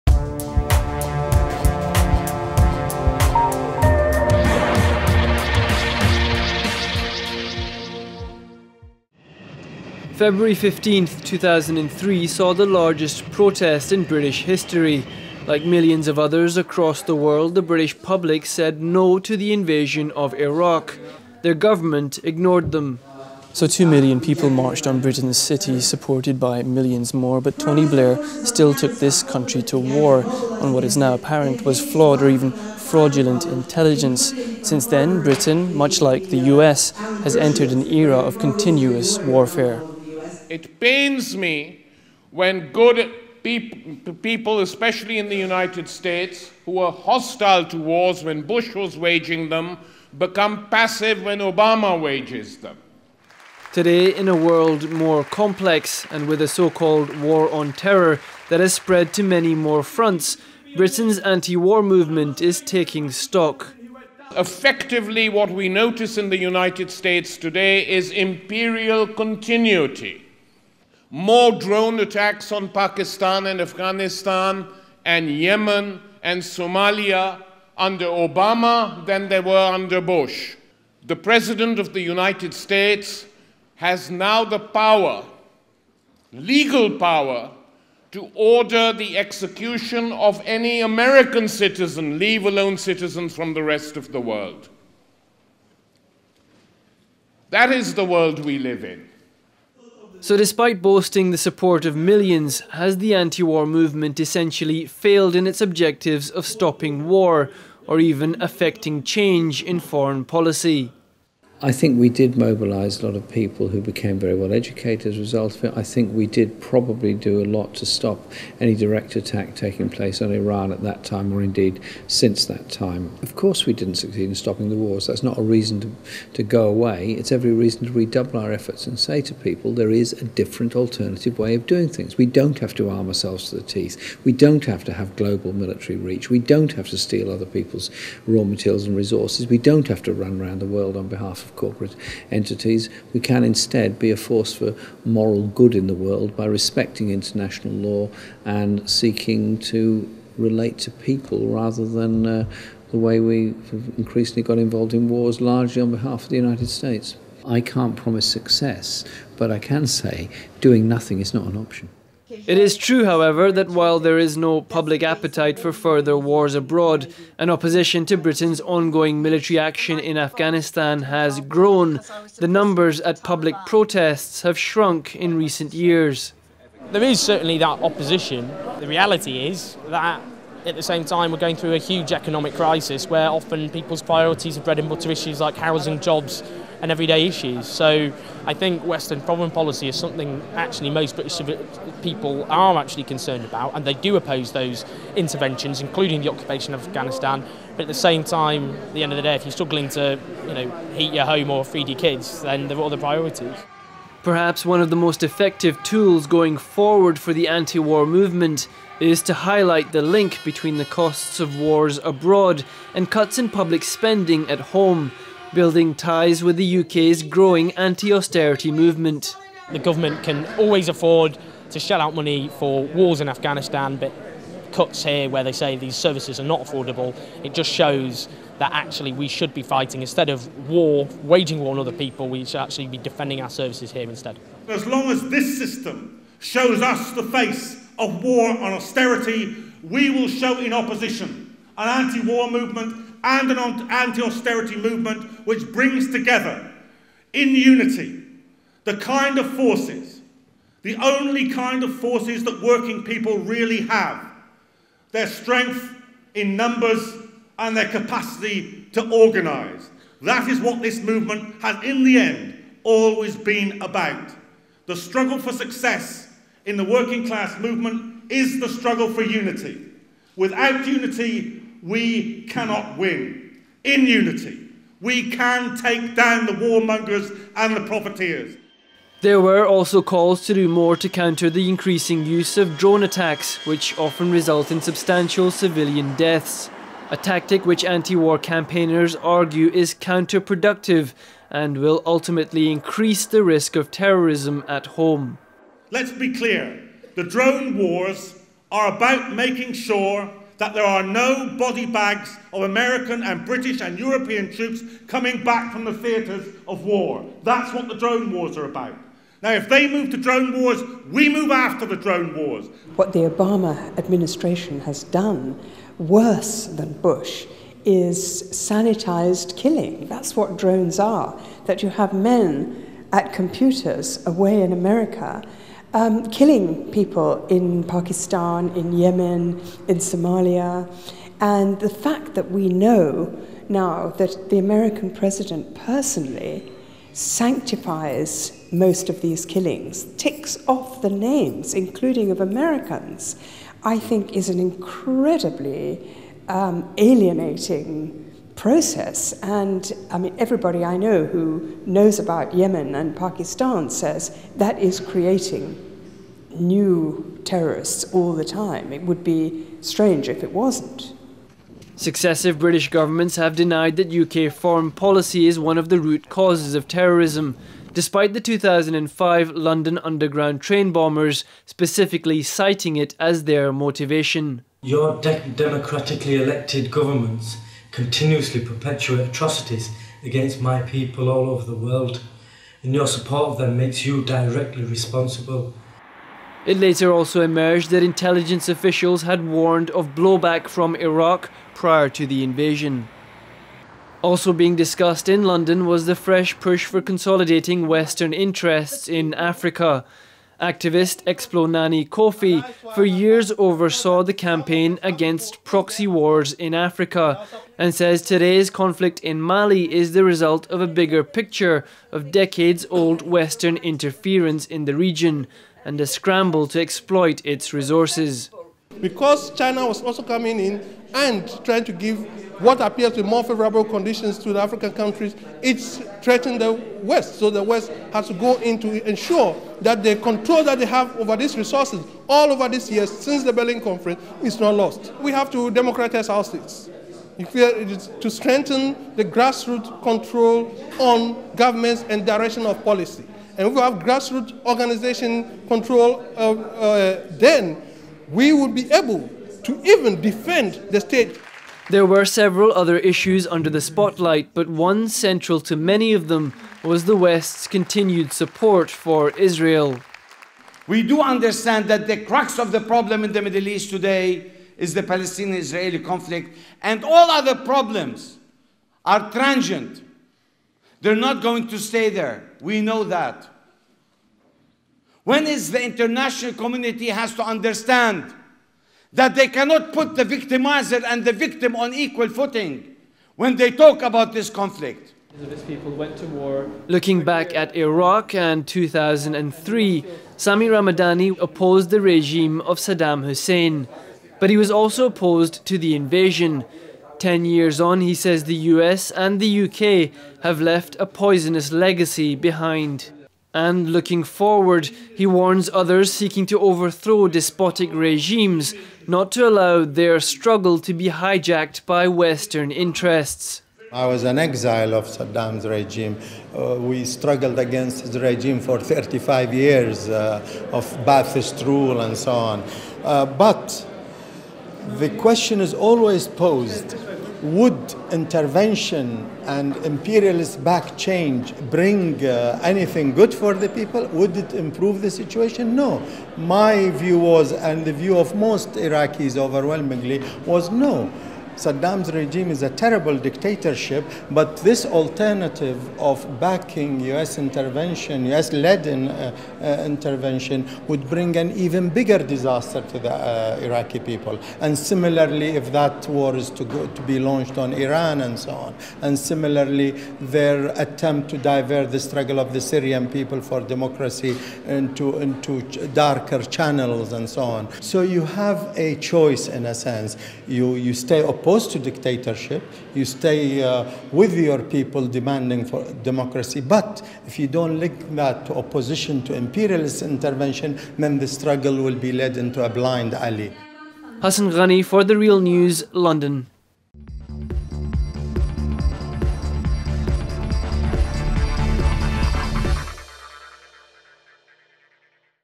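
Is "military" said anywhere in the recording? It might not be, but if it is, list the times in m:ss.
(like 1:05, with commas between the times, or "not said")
2:15, 2:49.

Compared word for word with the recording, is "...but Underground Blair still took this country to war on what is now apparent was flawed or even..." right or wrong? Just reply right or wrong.
wrong.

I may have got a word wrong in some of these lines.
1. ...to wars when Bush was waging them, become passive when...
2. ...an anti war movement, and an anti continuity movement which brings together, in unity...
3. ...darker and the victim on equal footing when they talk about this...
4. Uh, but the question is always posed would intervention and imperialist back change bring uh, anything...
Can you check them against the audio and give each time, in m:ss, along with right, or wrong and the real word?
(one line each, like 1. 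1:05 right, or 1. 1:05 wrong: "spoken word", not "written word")
1. 0:47 right
2. 4:01 wrong: "austerity", not "continuity"
3. 8:00 wrong: "victimizer", not "darker"
4. 8:43 right.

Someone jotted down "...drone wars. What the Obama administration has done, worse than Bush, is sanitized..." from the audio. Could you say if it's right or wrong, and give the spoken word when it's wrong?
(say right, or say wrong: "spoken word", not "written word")
right.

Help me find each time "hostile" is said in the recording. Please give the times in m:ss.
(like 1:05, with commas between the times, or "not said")
0:46.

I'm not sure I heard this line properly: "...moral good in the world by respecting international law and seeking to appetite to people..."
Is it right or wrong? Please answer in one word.
wrong.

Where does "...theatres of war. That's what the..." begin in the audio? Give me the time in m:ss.
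5:05.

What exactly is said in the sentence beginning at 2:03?
Of course, we didn't succeed in stopping the wars.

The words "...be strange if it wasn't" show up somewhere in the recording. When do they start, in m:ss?
5:59.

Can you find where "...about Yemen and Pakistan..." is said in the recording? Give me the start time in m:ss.
5:52.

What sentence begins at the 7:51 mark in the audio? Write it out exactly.
They're not going to stay there.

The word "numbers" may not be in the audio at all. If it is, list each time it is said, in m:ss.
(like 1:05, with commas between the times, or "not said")
2:52, 4:16.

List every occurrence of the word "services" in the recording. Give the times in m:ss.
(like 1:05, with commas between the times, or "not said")
3:45, 3:53.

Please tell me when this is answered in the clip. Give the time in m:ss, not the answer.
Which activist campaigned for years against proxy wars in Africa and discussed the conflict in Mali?
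6:41.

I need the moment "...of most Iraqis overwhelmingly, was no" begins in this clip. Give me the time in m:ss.
8:58.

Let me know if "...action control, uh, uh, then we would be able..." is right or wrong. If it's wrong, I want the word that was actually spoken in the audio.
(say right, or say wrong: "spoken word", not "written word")
wrong: "organization", not "action".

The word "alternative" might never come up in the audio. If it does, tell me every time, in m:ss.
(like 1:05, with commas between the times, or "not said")
2:10, 9:04.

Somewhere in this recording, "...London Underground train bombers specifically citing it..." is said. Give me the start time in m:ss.
6:09.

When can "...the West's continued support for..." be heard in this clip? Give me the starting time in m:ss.
7:37.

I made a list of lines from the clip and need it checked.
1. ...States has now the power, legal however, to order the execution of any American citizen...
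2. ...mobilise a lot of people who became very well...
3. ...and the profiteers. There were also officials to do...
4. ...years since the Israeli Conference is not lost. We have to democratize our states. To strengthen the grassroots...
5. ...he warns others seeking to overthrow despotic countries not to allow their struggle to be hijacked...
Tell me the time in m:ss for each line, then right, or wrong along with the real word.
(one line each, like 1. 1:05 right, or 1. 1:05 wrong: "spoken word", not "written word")
1. 1:22 wrong: "power", not "however"
2. 1:52 right
3. 4:37 wrong: "calls", not "officials"
4. 7:12 wrong: "Berlin", not "Israeli"
5. 8:25 wrong: "regimes", not "countries".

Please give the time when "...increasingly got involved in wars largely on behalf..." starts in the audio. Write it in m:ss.
2:33.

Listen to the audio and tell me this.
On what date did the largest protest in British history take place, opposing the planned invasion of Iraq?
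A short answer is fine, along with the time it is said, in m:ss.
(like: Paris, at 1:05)
February 15, 2003, at 0:10.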